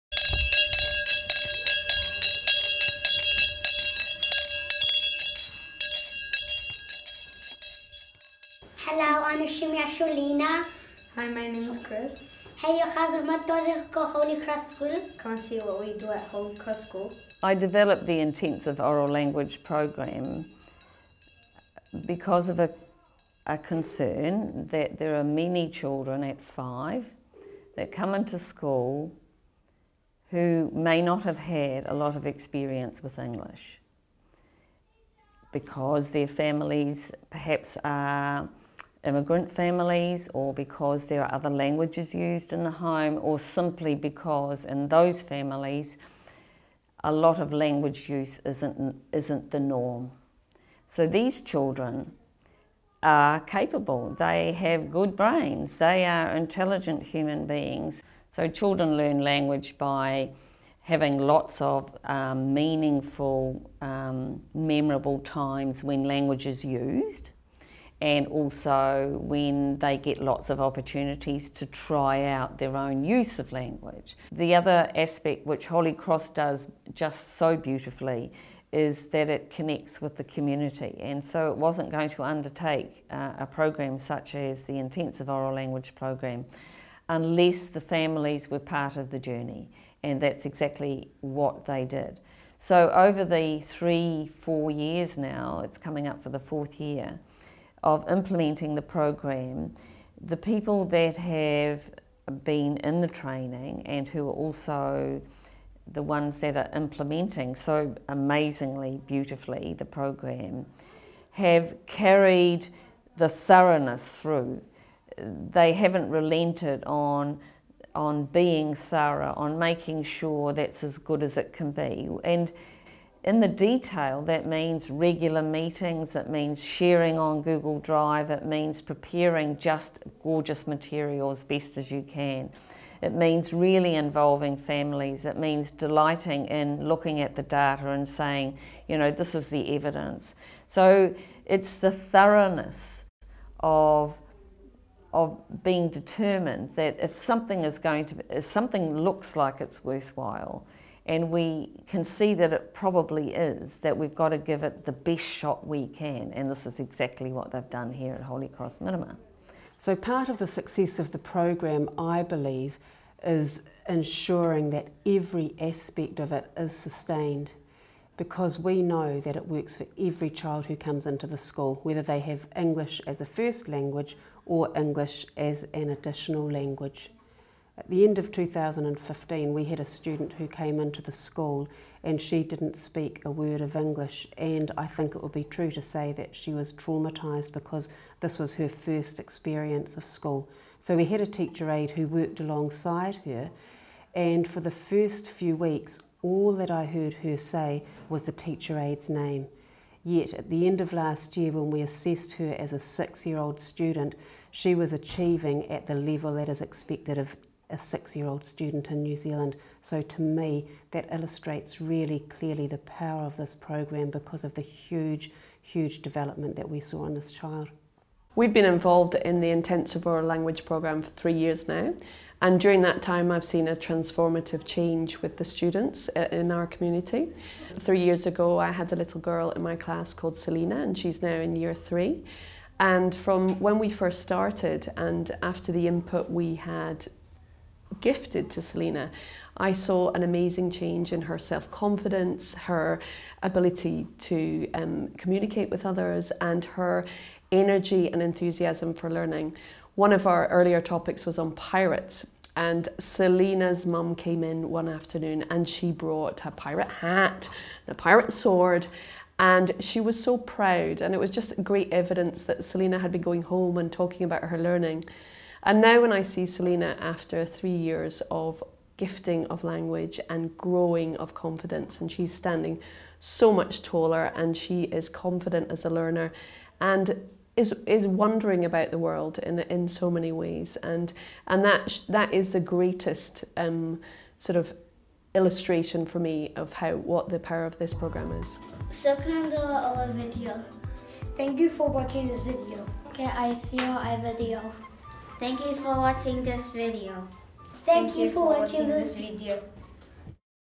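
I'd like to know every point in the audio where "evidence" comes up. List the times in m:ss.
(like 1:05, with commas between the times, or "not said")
2:19, 4:21.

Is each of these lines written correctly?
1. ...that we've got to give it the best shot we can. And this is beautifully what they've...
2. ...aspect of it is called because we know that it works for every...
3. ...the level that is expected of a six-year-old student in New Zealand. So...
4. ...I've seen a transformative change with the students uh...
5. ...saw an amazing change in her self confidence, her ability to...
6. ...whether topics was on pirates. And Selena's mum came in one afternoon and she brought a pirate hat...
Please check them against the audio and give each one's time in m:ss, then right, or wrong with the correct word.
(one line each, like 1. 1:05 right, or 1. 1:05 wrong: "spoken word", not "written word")
1. 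2:33 wrong: "exactly", not "beautifully"
2. 2:45 wrong: "sustained", not "called"
3. 3:25 right
4. 3:43 right
5. 3:59 right
6. 4:10 wrong: "earlier", not "whether".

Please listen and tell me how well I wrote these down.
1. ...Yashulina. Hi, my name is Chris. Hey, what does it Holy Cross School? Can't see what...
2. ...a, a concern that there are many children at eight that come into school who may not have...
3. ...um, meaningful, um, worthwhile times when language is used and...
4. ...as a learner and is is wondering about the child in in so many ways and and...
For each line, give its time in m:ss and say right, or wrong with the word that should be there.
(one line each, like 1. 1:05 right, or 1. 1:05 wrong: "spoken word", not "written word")
1. 0:09 right
2. 0:22 wrong: "five", not "eight"
3. 1:02 wrong: "memorable", not "worthwhile"
4. 4:35 wrong: "world", not "child".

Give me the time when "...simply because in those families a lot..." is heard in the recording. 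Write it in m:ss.
0:43.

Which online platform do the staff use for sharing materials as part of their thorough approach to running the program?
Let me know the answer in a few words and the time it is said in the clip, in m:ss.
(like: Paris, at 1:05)
Google Drive, at 2:07.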